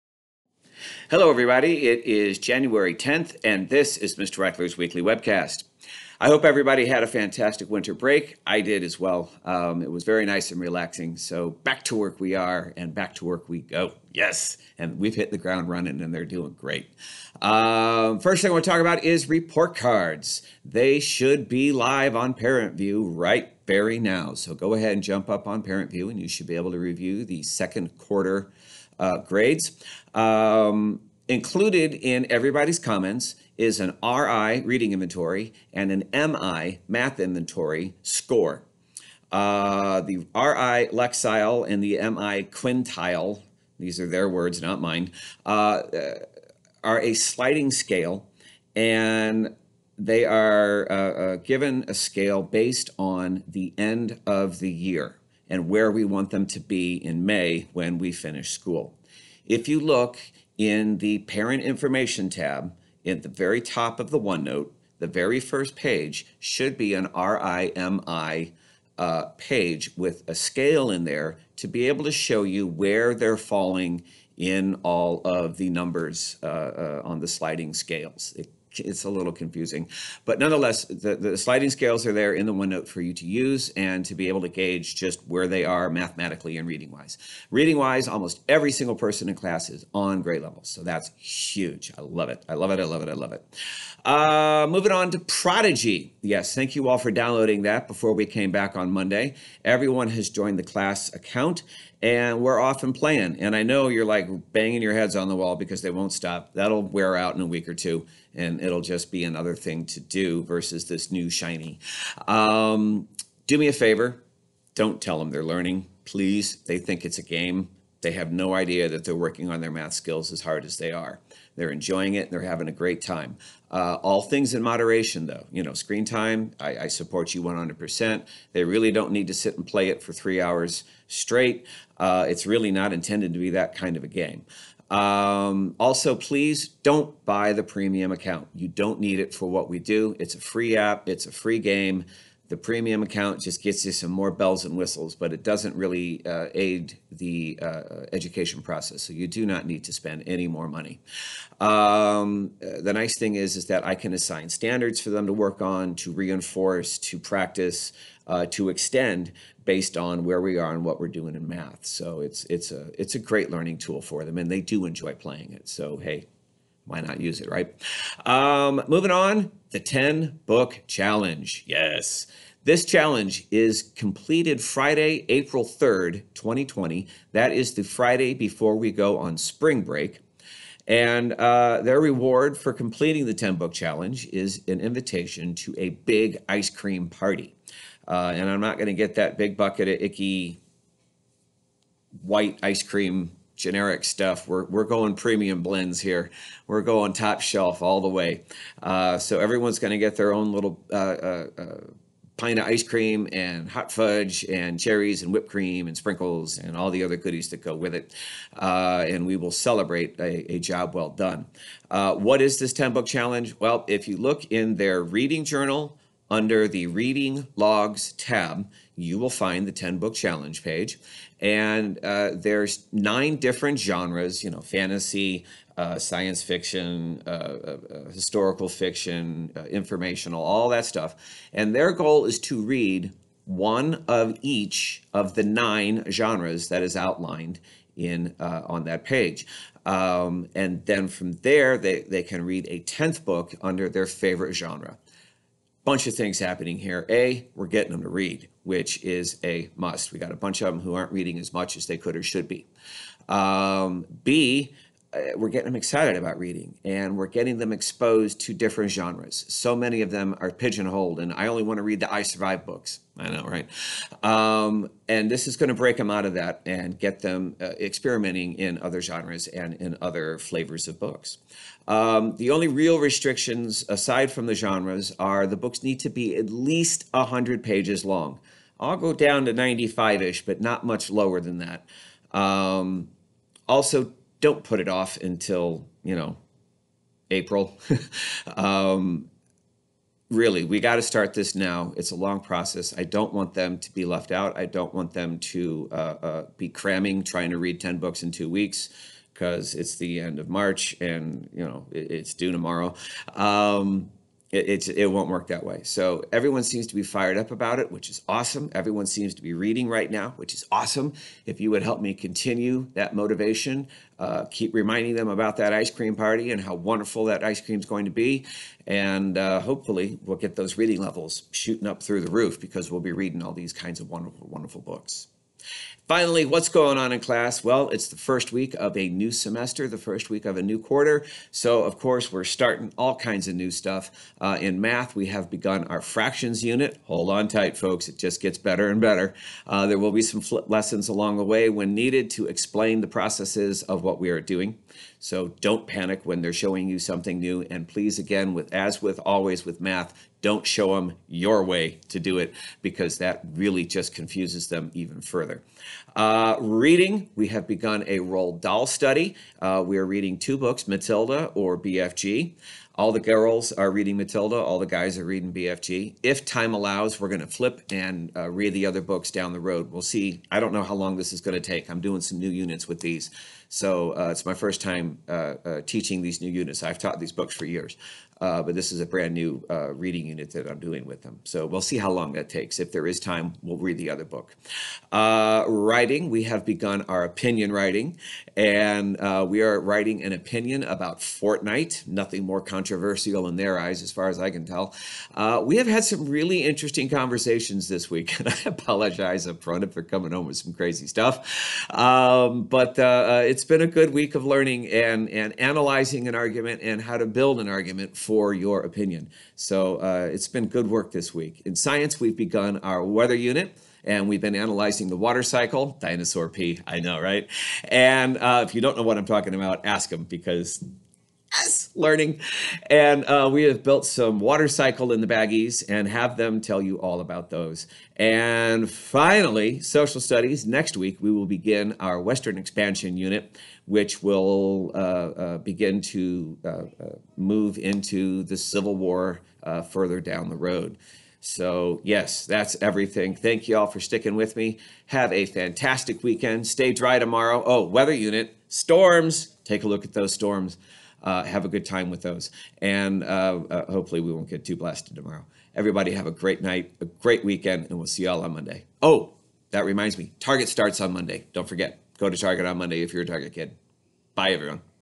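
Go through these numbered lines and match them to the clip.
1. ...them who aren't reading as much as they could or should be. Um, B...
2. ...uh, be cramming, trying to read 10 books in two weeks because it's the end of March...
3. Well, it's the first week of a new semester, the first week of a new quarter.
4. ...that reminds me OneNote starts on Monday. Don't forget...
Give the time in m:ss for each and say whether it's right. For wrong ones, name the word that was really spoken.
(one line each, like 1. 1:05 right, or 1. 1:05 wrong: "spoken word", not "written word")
1. 4:10 right
2. 4:55 right
3. 5:27 right
4. 7:39 wrong: "Target", not "OneNote".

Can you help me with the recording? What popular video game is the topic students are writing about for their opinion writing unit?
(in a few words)
Fortnite.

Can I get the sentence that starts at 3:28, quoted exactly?
Uh, and we will celebrate a, a job well done.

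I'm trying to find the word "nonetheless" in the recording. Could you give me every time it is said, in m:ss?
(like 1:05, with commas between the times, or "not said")
1:20.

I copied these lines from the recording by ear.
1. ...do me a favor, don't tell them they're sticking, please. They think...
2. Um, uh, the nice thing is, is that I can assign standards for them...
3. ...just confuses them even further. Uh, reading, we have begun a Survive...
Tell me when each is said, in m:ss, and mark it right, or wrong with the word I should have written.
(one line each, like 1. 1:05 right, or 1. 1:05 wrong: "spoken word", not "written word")
1. 1:53 wrong: "learning", not "sticking"
2. 2:31 right
3. 5:53 wrong: "Roald", not "Survive".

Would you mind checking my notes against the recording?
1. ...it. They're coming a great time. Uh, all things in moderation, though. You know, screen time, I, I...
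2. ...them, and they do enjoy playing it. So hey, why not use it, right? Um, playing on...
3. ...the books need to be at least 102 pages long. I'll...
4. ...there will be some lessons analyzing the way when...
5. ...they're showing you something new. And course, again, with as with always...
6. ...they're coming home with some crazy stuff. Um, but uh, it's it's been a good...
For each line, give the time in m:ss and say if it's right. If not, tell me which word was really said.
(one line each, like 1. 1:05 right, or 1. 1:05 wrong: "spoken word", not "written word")
1. 2:02 wrong: "having", not "coming"
2. 2:44 wrong: "moving", not "playing"
3. 4:35 wrong: "100", not "102"
4. 5:39 wrong: "along", not "analyzing"
5. 5:46 wrong: "please", not "course"
6. 6:39 right.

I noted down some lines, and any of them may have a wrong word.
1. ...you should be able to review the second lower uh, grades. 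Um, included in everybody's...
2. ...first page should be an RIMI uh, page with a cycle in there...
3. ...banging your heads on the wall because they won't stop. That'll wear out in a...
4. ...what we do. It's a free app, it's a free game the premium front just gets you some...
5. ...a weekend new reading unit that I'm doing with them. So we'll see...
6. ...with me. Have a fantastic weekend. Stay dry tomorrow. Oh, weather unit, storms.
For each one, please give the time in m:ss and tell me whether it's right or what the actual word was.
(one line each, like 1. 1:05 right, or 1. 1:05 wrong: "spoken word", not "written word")
1. 0:26 wrong: "quarter", not "lower"
2. 1:05 wrong: "scale", not "cycle"
3. 1:44 right
4. 2:19 wrong: "account", not "front"
5. 6:18 wrong: "brand", not "weekend"
6. 7:24 right.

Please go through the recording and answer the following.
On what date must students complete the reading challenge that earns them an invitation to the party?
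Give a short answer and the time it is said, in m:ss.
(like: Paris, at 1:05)
Friday, April 3rd, 2020, at 2:54.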